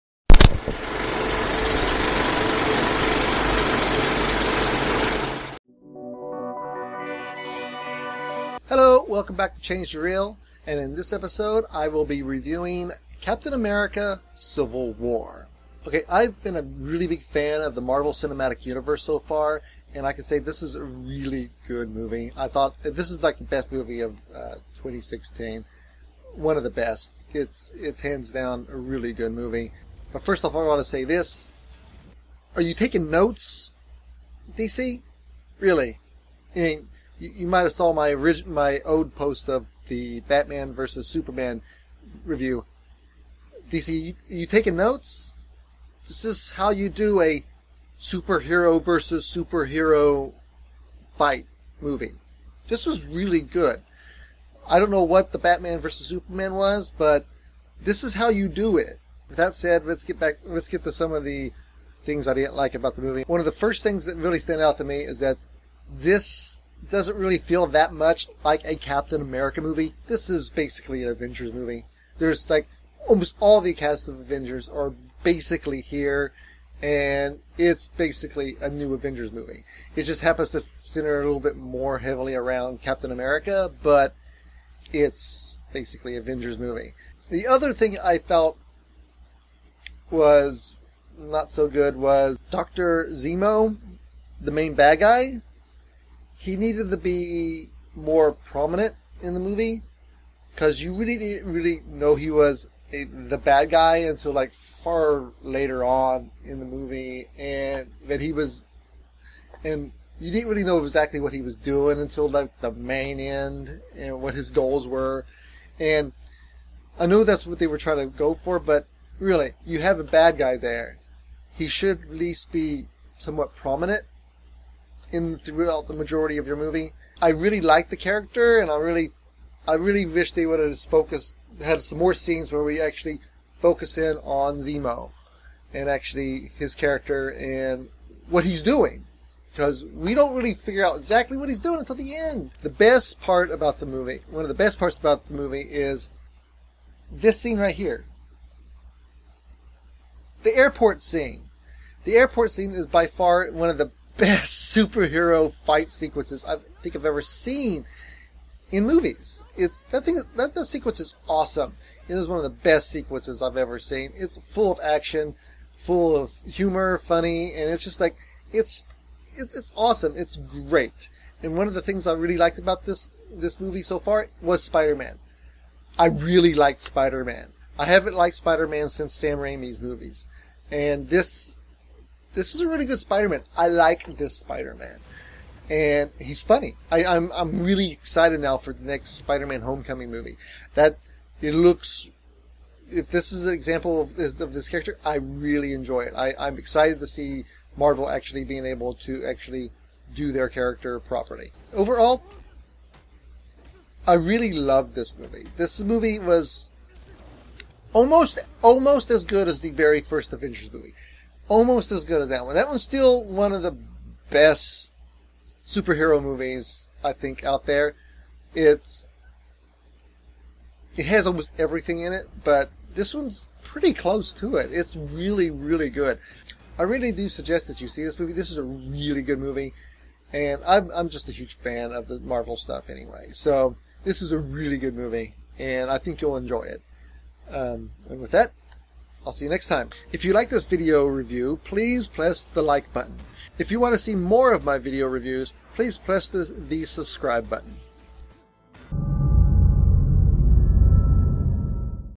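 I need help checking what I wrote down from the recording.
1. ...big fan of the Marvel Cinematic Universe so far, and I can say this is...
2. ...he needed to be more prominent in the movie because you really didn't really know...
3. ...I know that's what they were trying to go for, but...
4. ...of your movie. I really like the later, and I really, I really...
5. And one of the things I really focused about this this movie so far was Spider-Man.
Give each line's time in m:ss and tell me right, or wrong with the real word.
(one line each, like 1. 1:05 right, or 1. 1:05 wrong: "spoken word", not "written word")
1. 0:17 right
2. 1:36 right
3. 1:56 right
4. 2:06 wrong: "character", not "later"
5. 2:51 wrong: "liked", not "focused".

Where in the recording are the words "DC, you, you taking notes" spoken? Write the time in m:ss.
0:43.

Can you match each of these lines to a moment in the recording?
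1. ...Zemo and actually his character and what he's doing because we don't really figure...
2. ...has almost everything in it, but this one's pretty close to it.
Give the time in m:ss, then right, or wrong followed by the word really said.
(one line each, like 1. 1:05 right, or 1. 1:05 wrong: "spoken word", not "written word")
1. 2:14 right
2. 3:41 right.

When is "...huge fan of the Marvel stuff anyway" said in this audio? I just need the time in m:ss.
3:51.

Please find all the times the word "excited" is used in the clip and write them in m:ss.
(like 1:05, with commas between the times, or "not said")
3:07, 3:16.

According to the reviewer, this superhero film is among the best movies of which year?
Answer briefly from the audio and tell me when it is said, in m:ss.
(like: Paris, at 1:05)
2016, at 0:24.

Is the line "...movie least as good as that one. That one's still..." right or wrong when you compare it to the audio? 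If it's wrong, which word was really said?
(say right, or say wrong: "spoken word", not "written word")
wrong: "almost", not "least".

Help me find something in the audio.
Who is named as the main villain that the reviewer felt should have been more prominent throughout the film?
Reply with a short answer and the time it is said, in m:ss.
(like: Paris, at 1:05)
Dr. Zemo, at 1:32.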